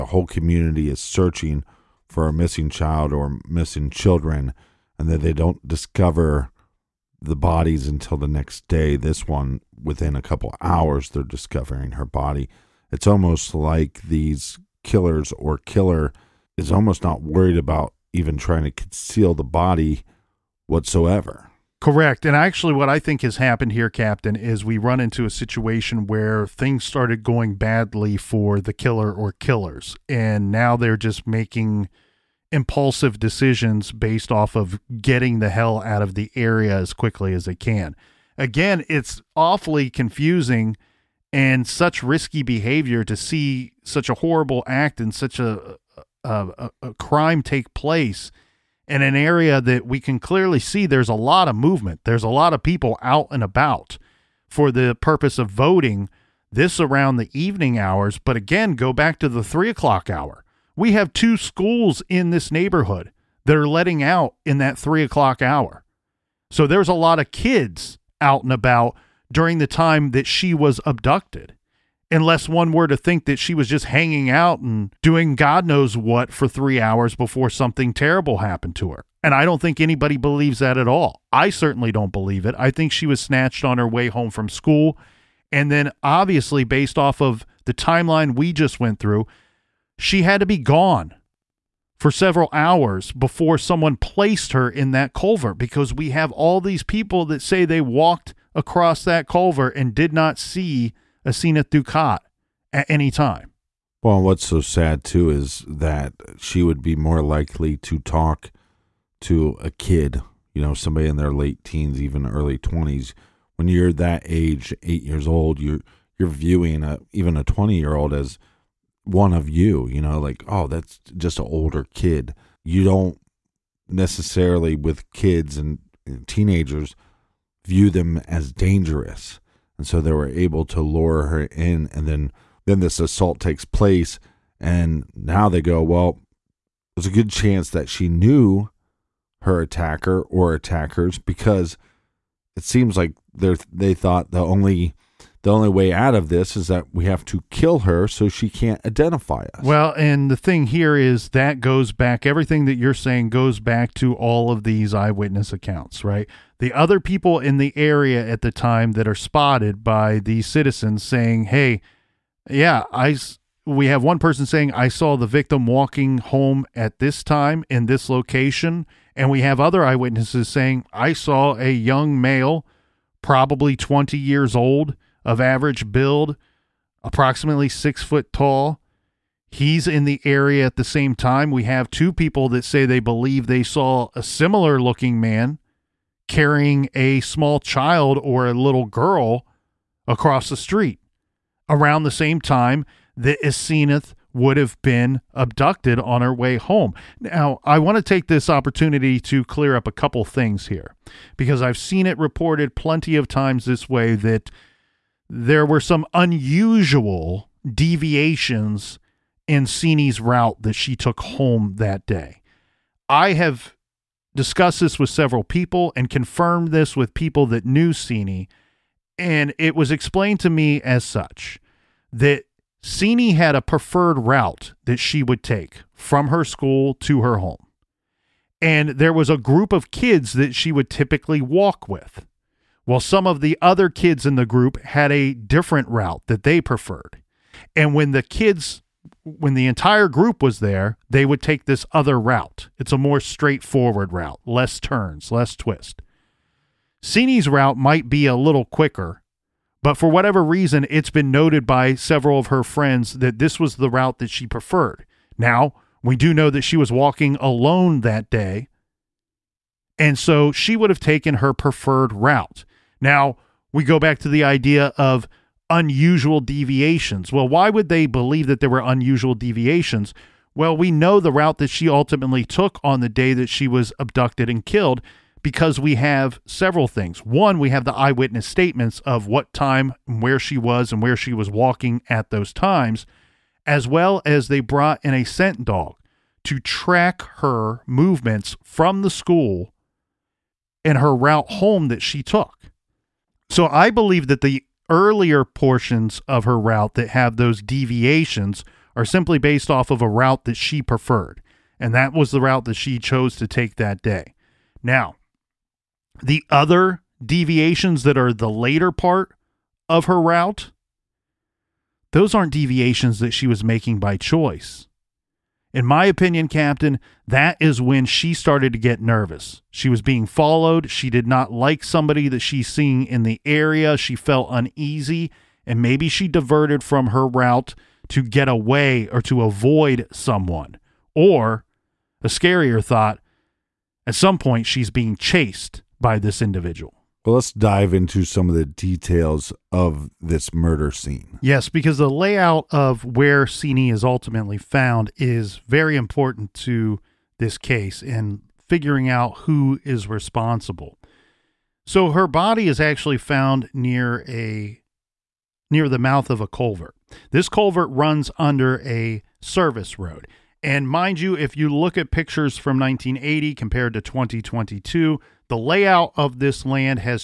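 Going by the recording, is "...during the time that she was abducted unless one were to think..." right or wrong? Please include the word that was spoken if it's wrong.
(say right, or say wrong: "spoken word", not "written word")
right.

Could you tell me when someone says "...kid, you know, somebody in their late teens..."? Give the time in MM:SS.
01:49.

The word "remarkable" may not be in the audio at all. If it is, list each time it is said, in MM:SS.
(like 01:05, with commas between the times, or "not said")
not said.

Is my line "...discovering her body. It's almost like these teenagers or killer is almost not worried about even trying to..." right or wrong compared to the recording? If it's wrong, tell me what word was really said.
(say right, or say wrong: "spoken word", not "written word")
wrong: "killers", not "teenagers".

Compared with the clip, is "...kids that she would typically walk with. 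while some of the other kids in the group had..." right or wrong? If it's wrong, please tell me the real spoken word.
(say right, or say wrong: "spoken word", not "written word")
right.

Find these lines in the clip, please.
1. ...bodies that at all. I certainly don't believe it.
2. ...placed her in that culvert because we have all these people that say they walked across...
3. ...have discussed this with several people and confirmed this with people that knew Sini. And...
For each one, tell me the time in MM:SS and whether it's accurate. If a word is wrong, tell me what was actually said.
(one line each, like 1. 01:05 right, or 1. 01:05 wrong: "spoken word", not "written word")
1. 01:20 wrong: "believes", not "bodies"
2. 01:33 right
3. 03:33 right.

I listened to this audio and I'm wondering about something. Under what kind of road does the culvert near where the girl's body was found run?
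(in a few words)
Service road.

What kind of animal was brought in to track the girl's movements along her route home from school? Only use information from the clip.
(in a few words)
Scent dog.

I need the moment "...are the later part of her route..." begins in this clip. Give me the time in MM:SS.
05:08.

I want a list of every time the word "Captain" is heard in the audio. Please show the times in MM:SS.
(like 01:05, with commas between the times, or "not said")
00:23, 05:16.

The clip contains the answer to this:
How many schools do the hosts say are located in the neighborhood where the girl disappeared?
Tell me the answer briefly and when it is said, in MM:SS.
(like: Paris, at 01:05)
2, at 01:01.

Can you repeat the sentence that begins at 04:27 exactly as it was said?
Well, why would they believe that there were unusual deviations?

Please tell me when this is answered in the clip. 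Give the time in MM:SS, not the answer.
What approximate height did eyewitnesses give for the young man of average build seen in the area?
02:57.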